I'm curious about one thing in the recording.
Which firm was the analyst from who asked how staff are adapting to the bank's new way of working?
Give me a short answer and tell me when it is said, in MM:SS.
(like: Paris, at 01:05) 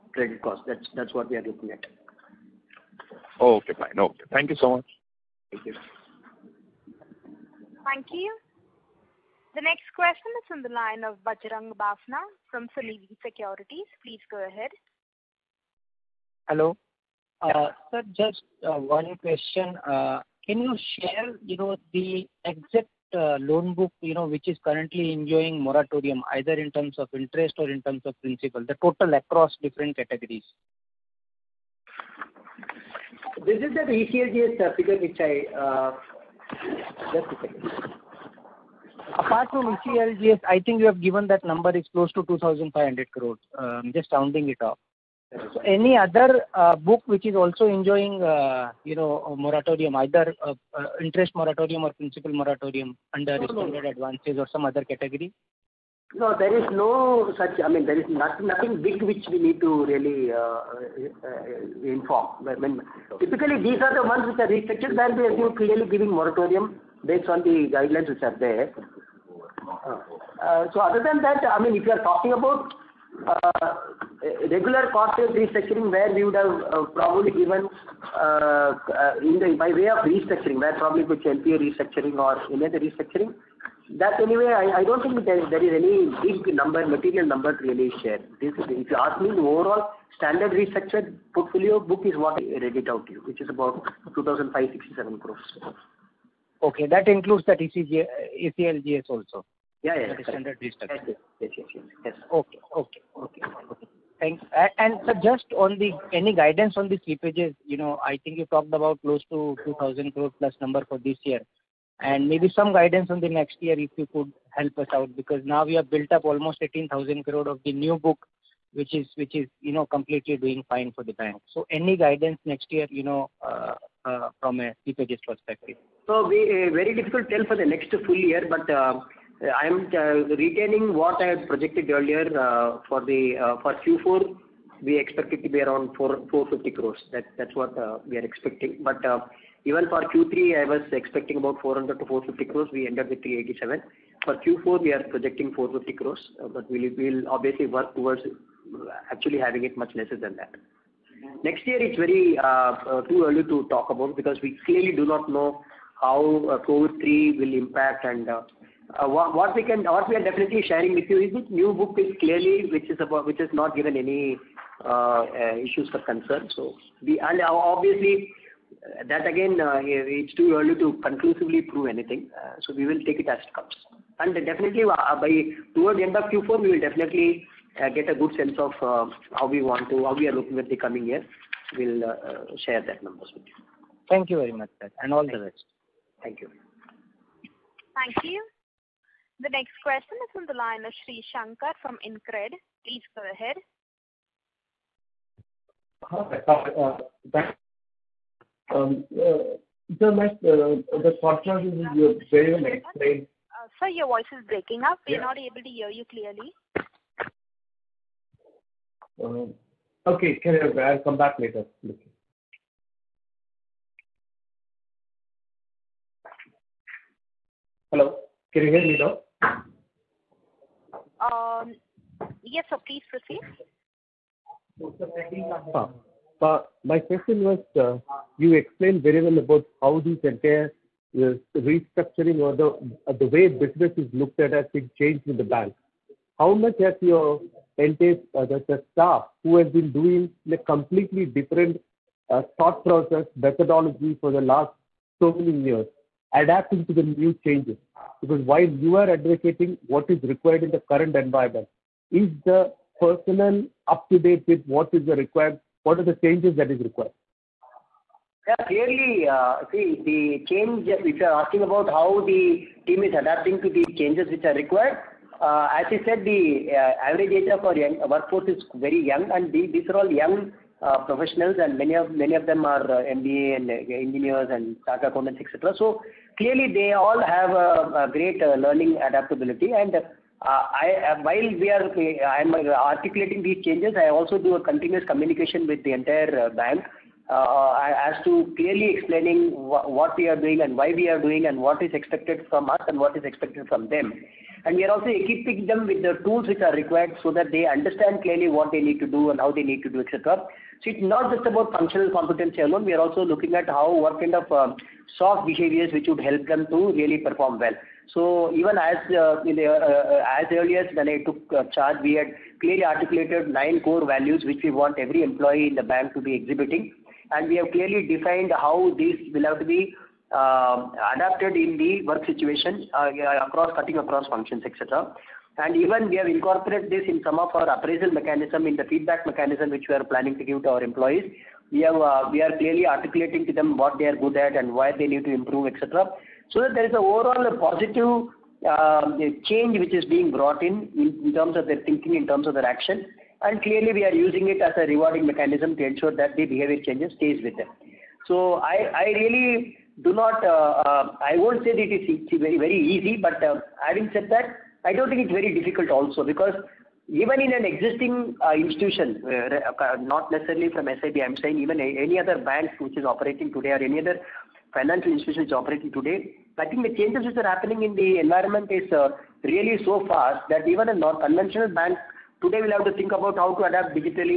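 InCred, at 03:12.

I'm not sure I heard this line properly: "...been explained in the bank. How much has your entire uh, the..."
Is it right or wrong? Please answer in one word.
wrong.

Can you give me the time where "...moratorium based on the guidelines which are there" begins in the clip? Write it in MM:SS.
01:06.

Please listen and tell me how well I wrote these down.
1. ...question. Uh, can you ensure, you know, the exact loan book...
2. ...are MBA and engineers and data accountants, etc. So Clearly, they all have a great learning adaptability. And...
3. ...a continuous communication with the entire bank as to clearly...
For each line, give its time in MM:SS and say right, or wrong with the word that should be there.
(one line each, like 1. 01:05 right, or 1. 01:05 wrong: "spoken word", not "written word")
1. 00:19 wrong: "share", not "ensure"
2. 04:32 right
3. 04:44 right.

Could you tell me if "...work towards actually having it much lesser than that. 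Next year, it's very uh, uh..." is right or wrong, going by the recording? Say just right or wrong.
right.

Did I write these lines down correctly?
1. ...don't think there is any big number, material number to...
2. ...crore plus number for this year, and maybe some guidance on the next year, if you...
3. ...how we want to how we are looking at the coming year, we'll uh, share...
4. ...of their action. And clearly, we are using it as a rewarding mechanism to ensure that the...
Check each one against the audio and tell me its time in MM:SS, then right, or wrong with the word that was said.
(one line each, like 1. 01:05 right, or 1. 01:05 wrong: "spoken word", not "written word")
1. 01:24 right
2. 01:50 right
3. 02:59 right
4. 05:42 right.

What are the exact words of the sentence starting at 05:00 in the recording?
So It's not just about functional competency alone.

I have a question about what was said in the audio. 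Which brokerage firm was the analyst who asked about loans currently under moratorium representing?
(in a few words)
Sunidhi Securities.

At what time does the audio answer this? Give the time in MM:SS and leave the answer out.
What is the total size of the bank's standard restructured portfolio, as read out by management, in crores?
01:34.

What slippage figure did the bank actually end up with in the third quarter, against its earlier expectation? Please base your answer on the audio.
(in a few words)
387 crores.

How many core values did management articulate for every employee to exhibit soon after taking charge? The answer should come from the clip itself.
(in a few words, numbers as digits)
9.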